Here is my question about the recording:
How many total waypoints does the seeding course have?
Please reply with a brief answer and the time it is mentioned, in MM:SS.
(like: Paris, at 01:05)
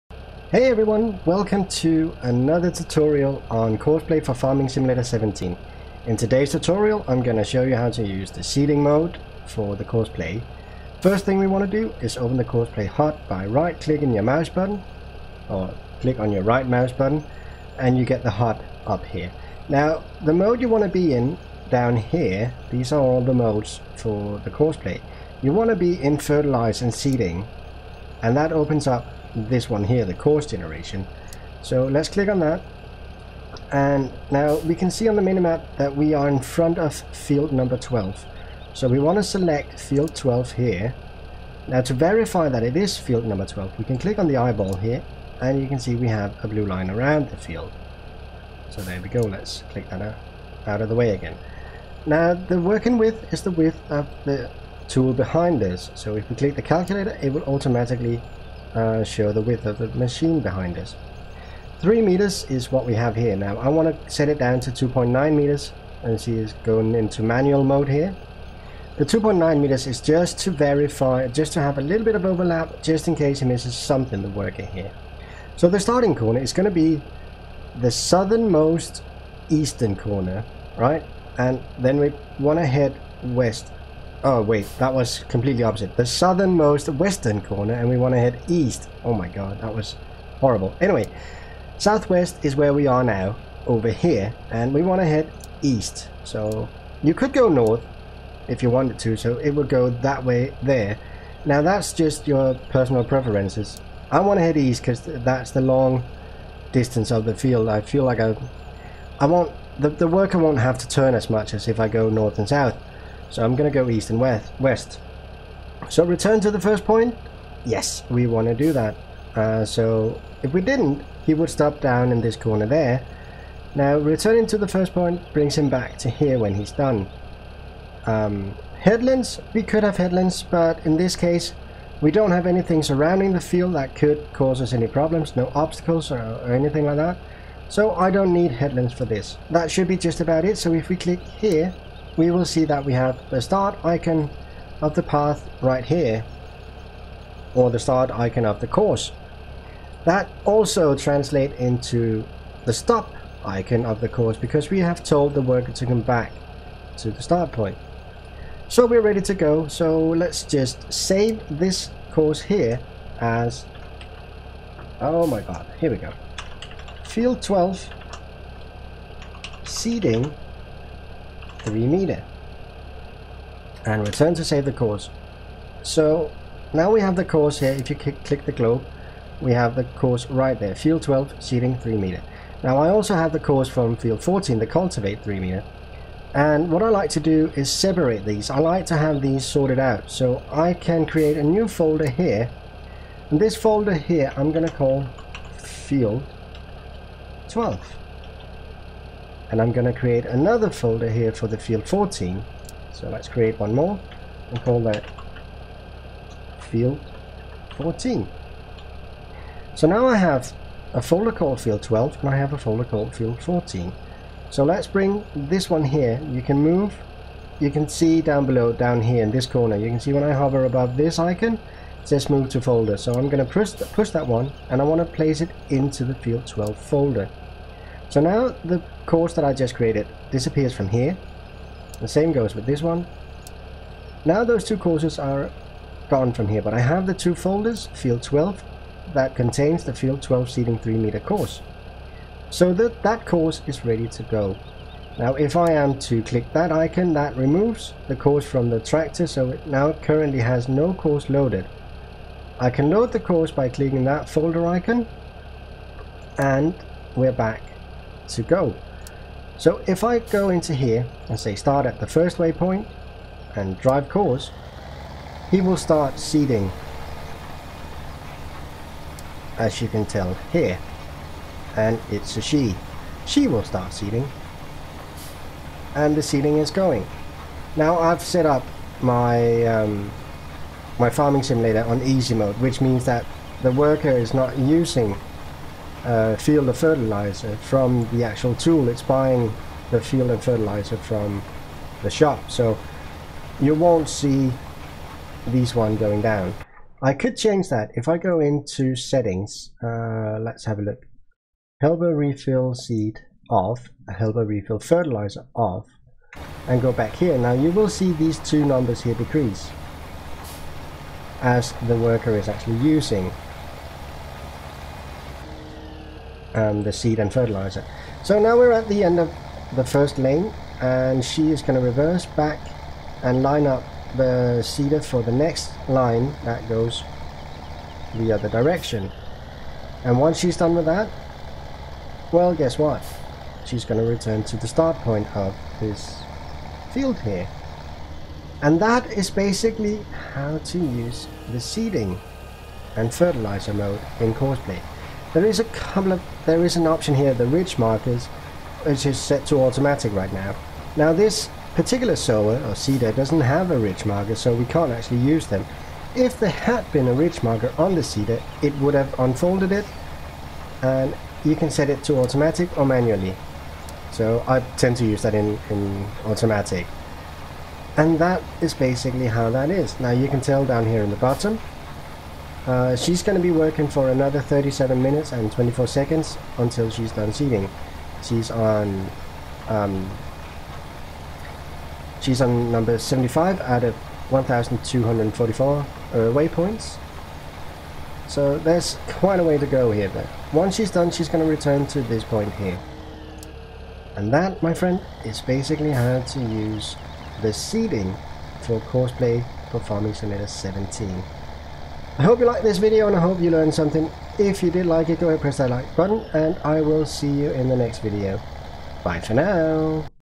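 1,244, at 06:24.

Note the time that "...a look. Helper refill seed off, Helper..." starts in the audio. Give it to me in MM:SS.
05:00.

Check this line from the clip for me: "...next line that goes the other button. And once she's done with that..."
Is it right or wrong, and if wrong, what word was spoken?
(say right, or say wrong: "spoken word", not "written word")
wrong: "direction", not "button".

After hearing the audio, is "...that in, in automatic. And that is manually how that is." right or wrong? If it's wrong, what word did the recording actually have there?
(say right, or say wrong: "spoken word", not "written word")
wrong: "basically", not "manually".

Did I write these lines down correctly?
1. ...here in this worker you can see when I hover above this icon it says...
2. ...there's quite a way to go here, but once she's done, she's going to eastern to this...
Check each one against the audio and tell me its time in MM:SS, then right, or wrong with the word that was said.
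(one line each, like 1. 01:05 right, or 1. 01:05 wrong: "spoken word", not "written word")
1. 03:39 wrong: "corner", not "worker"
2. 06:28 wrong: "return", not "eastern".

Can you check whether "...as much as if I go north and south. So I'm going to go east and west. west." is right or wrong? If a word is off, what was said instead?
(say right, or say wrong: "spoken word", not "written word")
right.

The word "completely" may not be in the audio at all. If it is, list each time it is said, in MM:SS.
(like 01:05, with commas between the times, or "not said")
01:25.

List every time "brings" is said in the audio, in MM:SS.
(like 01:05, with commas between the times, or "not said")
02:05, 03:34.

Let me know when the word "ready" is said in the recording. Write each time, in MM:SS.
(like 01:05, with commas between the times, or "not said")
02:39, 04:03.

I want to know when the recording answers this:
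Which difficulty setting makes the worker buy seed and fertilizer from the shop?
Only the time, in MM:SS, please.
04:42.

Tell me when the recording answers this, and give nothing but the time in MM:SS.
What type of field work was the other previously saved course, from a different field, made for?
03:04.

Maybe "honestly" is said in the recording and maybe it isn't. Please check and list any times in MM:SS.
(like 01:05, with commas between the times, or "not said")
not said.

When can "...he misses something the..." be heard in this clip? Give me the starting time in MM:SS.
01:13.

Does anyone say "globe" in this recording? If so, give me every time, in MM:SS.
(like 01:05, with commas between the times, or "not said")
02:58.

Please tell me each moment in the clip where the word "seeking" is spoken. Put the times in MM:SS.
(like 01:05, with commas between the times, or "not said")
not said.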